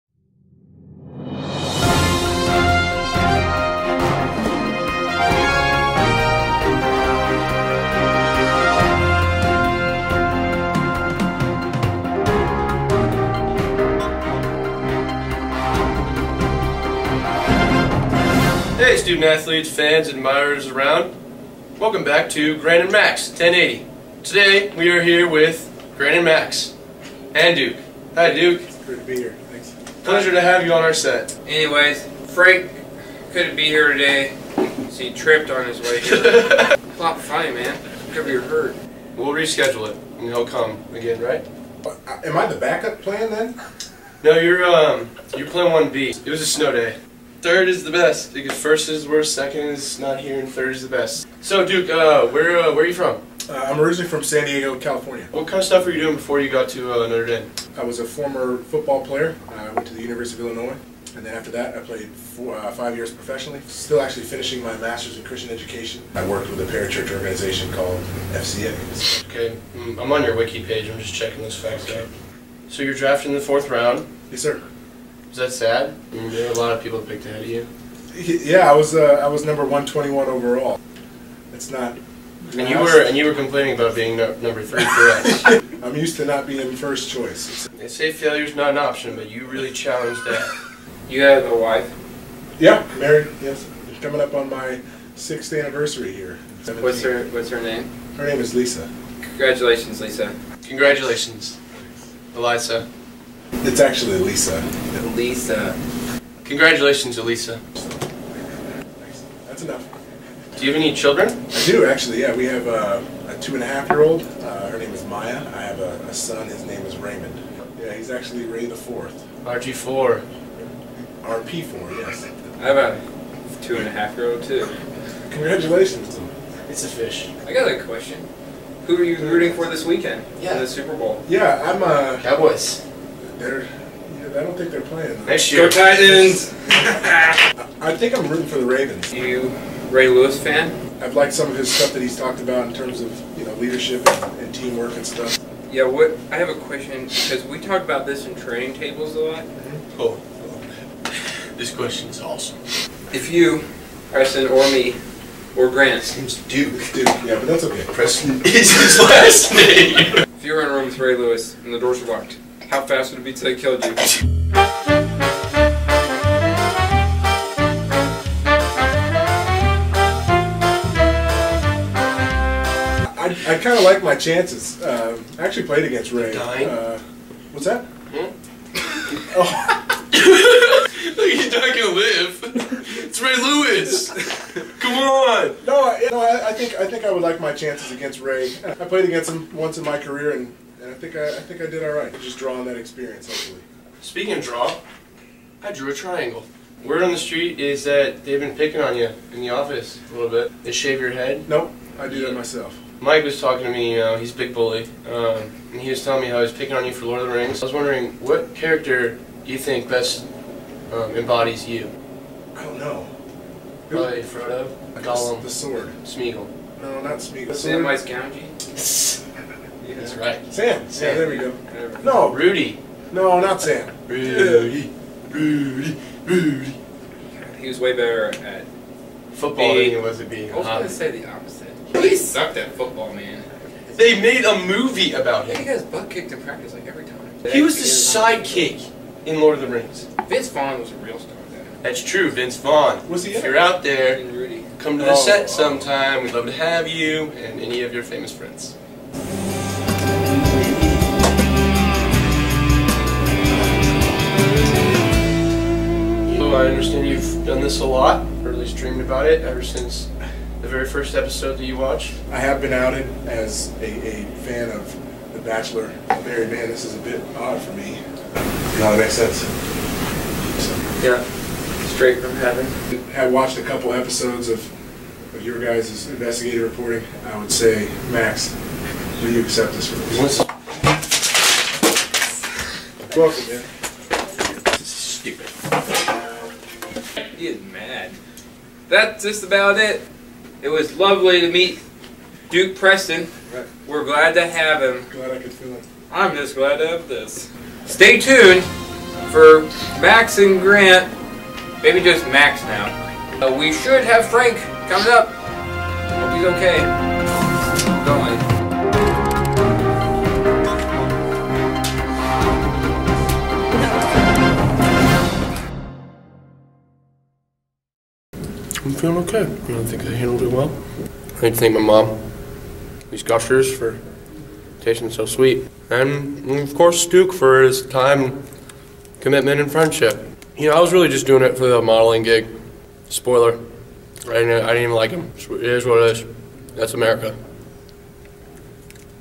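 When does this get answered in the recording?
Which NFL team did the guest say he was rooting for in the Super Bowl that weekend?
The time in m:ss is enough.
2:18.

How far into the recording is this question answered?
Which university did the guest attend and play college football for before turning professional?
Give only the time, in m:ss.
1:00.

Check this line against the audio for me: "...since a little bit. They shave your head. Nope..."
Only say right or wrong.
wrong.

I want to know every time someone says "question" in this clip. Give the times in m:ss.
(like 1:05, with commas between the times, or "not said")
2:07, 2:26, 2:31.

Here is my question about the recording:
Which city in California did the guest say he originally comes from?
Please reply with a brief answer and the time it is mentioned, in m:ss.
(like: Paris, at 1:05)
San Diego, at 0:54.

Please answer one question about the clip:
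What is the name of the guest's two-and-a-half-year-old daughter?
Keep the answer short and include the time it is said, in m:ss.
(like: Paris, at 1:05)
Maya, at 1:55.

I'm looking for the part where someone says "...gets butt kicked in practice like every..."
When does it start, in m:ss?
3:55.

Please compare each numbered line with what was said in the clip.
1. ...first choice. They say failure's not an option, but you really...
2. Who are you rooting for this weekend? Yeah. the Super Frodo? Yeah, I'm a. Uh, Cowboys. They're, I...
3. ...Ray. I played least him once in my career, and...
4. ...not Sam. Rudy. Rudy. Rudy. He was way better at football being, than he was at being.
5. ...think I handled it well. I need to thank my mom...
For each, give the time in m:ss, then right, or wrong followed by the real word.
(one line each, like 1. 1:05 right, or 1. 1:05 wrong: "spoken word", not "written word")
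1. 1:26 right
2. 2:08 wrong: "Bowl", not "Frodo"
3. 3:08 wrong: "against", not "least"
4. 3:43 right
5. 5:19 right.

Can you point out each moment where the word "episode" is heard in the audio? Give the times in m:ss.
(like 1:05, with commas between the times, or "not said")
4:21, 4:33.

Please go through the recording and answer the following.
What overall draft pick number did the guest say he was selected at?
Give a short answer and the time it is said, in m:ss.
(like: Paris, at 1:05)
121, at 1:19.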